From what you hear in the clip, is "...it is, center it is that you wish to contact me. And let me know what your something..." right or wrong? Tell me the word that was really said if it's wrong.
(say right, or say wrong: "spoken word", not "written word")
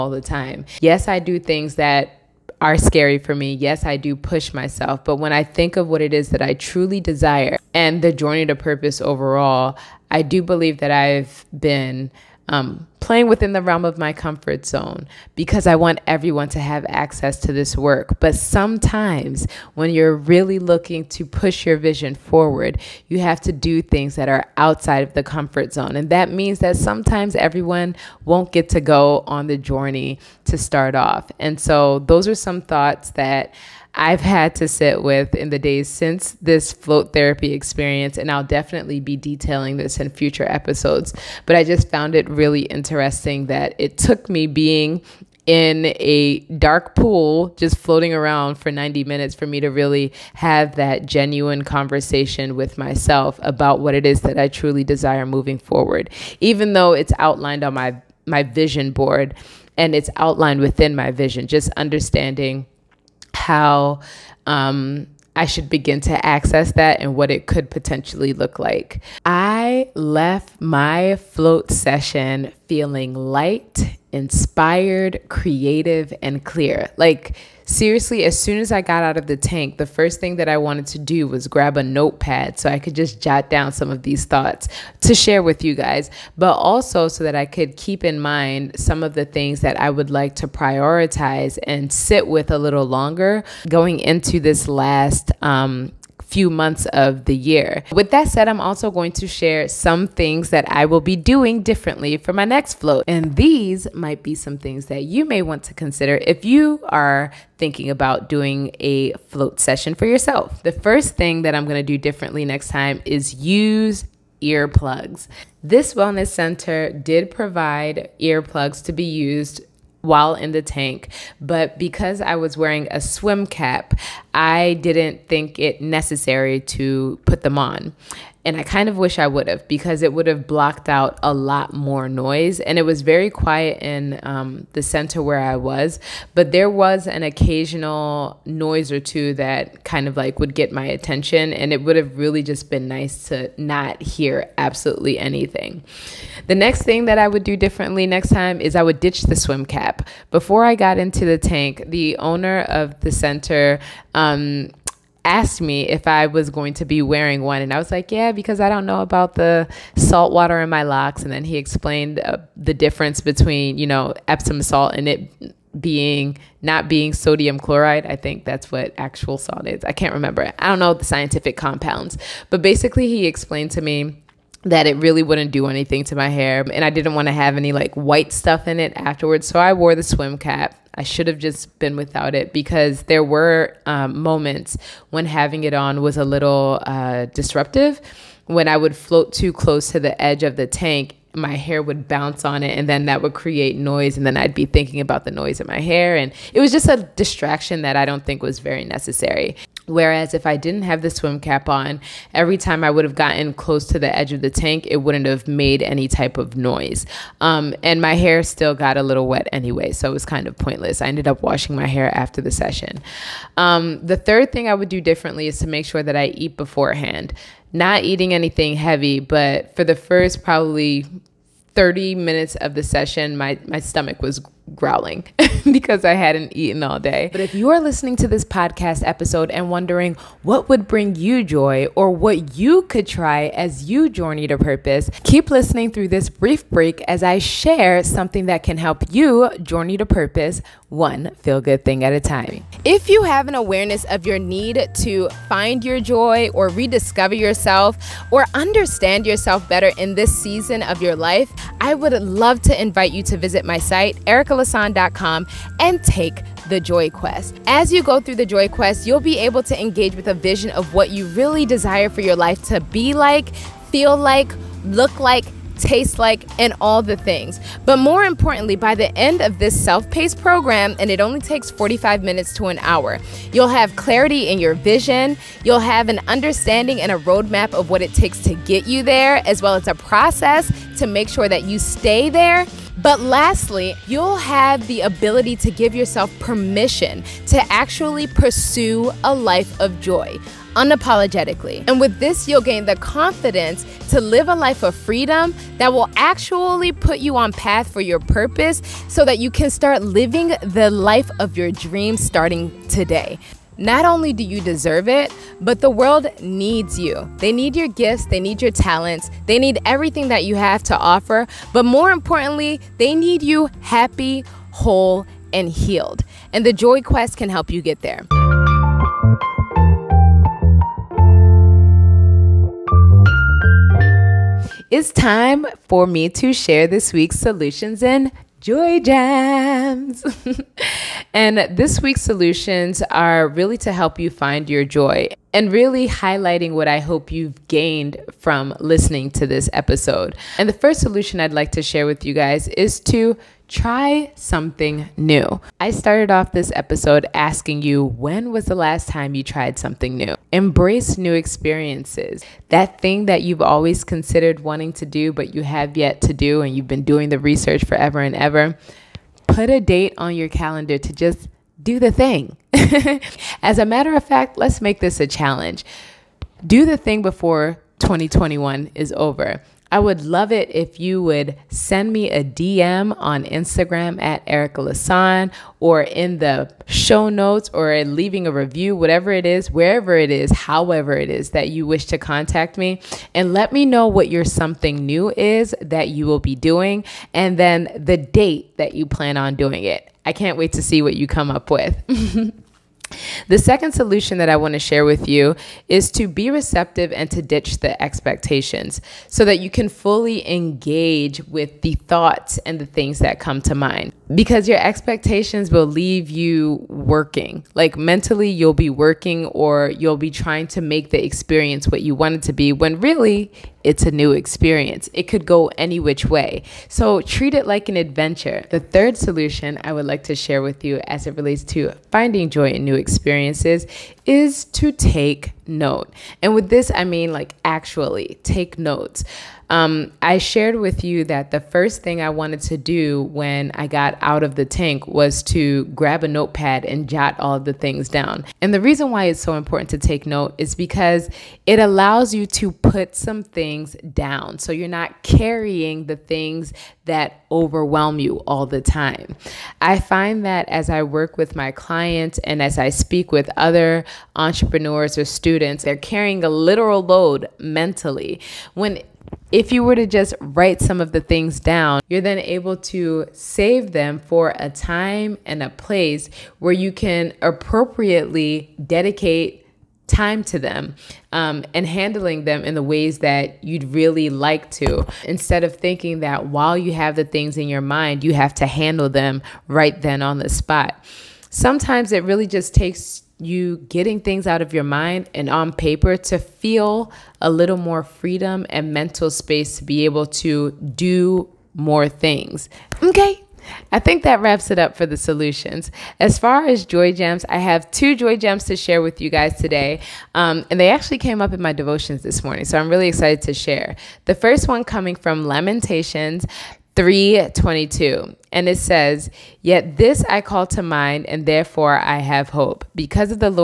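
wrong: "however", not "center".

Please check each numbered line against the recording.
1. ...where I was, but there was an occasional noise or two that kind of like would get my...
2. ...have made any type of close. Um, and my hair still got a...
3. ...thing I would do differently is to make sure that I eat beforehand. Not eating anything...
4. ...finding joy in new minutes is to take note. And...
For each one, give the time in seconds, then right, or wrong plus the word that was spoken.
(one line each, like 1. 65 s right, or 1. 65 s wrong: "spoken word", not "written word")
1. 135 s right
2. 205 s wrong: "noise", not "close"
3. 214 s right
4. 422 s wrong: "experiences", not "minutes".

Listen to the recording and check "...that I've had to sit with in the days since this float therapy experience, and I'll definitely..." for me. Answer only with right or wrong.
right.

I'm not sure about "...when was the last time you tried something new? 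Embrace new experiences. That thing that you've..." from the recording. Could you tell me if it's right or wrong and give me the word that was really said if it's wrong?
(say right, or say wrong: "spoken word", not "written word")
right.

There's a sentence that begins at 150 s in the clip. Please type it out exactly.
Before I got into the tank, the owner of the center um, asked me if I was going to be wearing one.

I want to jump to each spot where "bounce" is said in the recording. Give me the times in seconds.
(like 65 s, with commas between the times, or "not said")
192 s.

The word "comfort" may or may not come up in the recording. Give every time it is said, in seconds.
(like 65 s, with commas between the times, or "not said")
14 s, 25 s.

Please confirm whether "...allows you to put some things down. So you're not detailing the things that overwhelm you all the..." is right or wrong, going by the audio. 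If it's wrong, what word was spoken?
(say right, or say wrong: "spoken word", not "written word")
wrong: "carrying", not "detailing".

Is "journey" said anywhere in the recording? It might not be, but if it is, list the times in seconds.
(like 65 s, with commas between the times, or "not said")
8 s, 29 s, 234 s, 239 s.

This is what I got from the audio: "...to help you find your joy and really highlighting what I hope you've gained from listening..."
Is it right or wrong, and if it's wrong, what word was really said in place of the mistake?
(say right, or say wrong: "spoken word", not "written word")
right.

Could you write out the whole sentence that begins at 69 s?
I left my float session feeling light inspired, creative, and clear.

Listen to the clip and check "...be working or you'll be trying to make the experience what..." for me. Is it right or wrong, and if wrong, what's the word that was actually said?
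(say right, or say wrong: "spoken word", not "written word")
right.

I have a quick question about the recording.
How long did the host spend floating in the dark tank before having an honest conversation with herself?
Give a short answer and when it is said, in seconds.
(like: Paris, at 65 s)
90 minutes, at 48 s.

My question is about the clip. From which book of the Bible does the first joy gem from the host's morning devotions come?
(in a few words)
Lamentations.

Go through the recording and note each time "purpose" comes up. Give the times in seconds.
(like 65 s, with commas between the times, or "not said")
8 s, 234 s, 240 s, 298 s.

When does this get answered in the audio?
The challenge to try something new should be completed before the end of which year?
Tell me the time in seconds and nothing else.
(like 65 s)
367 s.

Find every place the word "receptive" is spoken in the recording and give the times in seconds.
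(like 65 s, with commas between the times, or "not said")
396 s.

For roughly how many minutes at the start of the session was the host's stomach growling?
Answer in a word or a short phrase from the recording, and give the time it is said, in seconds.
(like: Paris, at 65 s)
30, at 221 s.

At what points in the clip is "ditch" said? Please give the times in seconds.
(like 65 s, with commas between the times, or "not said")
148 s, 397 s.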